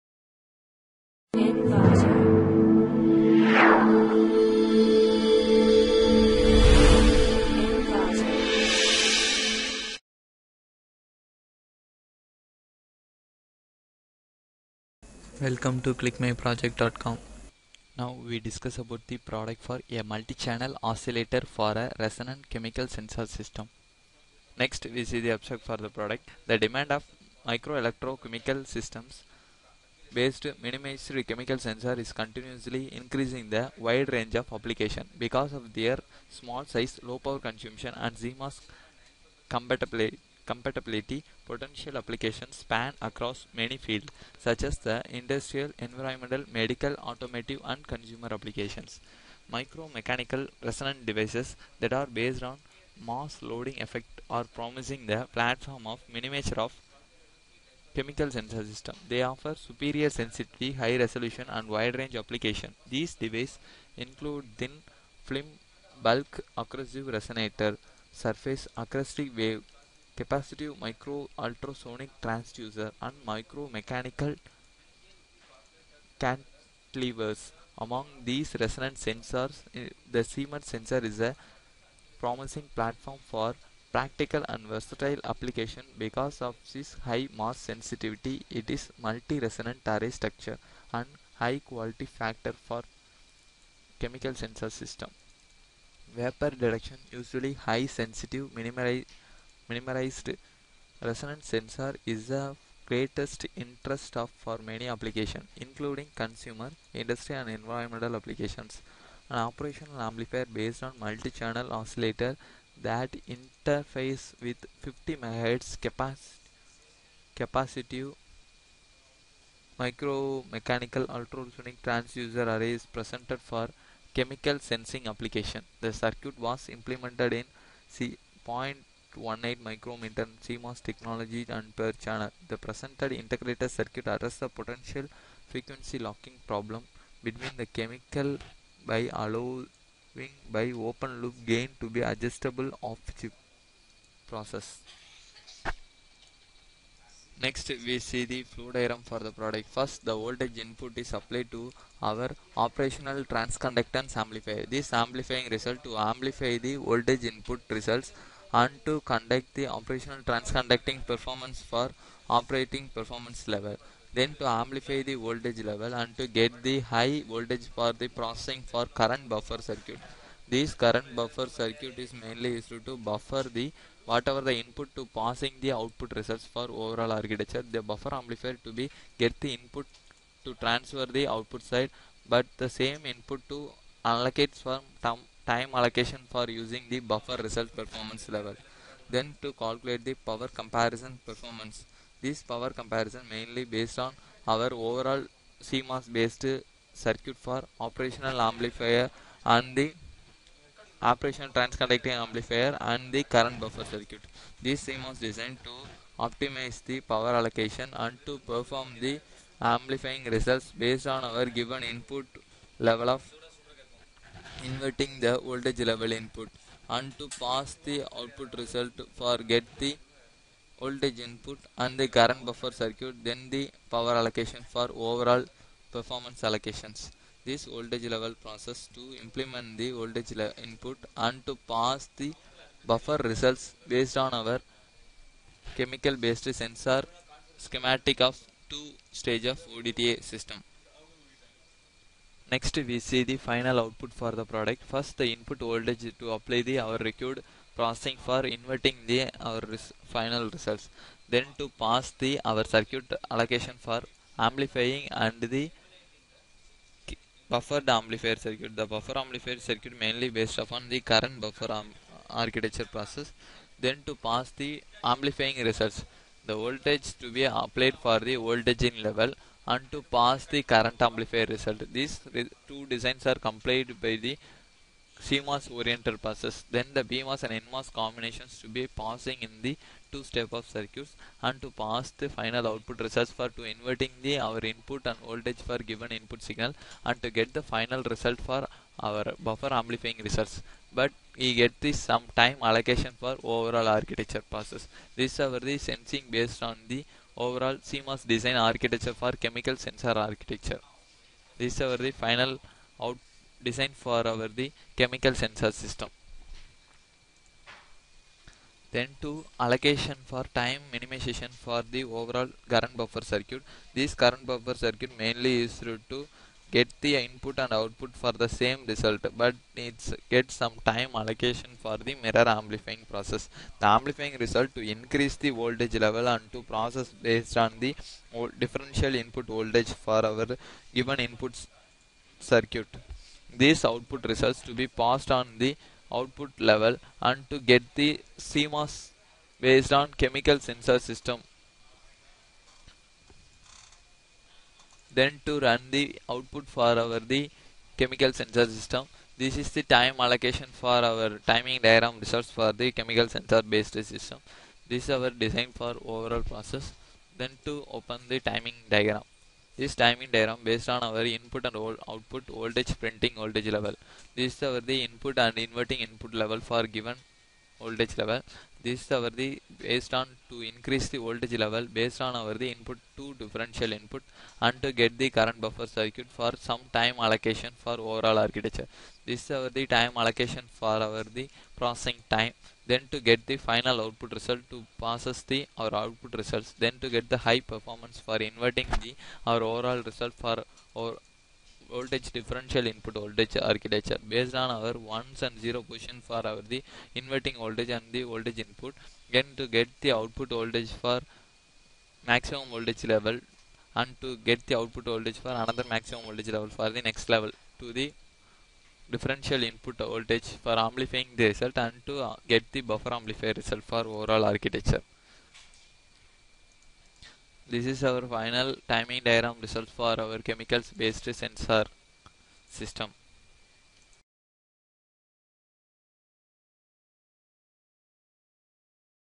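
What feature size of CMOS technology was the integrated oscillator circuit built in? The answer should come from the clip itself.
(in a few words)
0.18 micrometer.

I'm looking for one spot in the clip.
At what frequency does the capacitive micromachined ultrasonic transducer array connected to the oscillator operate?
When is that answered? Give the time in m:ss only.
1:54.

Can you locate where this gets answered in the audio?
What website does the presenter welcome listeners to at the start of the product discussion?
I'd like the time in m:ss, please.
0:15.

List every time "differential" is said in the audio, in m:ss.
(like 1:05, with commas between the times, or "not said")
5:28, 6:13, 6:32, 6:49.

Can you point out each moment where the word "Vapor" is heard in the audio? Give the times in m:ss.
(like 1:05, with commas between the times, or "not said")
1:36.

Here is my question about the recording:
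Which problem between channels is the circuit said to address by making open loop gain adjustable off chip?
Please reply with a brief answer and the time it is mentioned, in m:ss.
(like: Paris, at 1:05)
frequency locking, at 2:15.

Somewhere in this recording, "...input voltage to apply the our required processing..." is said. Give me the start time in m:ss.
4:05.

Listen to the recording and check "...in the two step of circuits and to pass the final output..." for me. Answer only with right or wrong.
right.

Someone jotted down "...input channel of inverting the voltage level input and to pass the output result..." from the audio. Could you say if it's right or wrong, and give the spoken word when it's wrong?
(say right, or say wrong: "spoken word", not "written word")
wrong: "level", not "channel".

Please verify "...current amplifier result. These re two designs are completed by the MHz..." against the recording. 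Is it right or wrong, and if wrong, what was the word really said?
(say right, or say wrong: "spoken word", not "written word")
wrong: "CMOS", not "MHz".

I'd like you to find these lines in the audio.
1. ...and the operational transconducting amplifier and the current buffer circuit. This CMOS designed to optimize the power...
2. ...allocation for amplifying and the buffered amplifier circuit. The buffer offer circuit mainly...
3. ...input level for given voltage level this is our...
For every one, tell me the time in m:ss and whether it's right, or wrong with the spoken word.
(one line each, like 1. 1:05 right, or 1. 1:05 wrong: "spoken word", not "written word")
1. 3:19 right
2. 4:13 wrong: "amplifier", not "offer"
3. 6:06 right.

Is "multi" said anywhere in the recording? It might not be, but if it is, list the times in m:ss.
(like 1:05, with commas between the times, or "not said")
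0:20, 1:29, 1:50.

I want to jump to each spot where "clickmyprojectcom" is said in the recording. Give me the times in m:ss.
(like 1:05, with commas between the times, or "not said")
0:15.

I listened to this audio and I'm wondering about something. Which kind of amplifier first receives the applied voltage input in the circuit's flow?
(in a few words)
operational transconductance amplifier.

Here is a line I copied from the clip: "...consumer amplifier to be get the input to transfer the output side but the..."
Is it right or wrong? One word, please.
wrong.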